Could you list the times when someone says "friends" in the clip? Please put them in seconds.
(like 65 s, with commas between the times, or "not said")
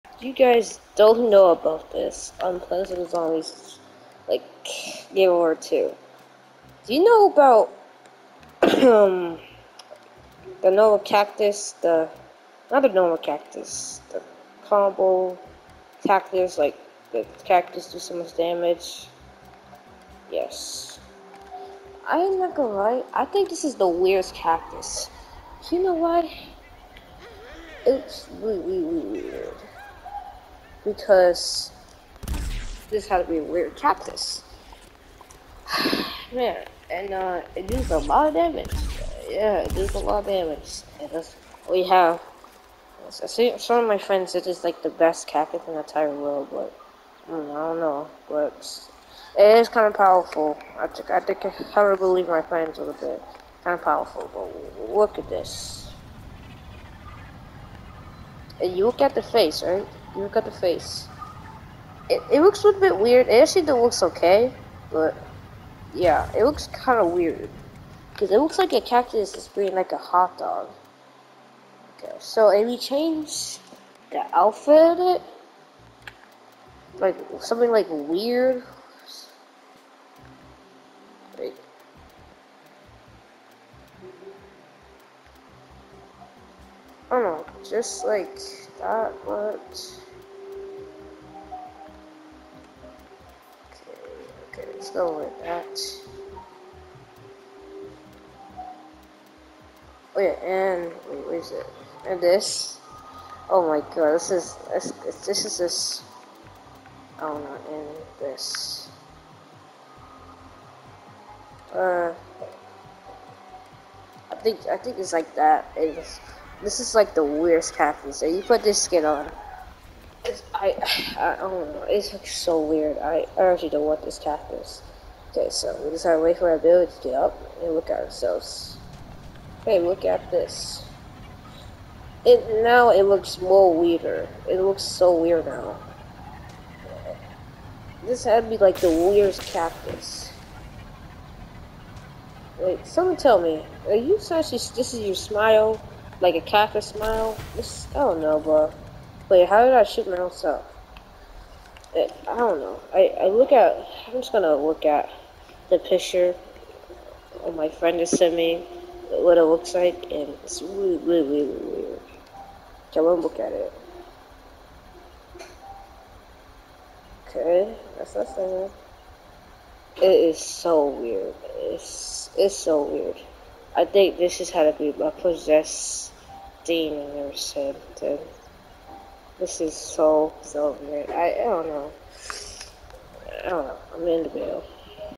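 43 s, 52 s, 157 s.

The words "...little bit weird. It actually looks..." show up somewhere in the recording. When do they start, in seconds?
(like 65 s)
62 s.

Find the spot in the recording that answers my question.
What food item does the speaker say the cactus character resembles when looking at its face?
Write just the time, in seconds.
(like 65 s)
69 s.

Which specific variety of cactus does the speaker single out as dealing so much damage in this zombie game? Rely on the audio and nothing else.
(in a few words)
combo cactus.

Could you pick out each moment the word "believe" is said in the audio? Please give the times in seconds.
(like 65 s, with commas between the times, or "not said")
51 s.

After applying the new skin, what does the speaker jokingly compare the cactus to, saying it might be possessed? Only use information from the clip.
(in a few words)
demon.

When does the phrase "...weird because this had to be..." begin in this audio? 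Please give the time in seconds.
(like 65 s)
29 s.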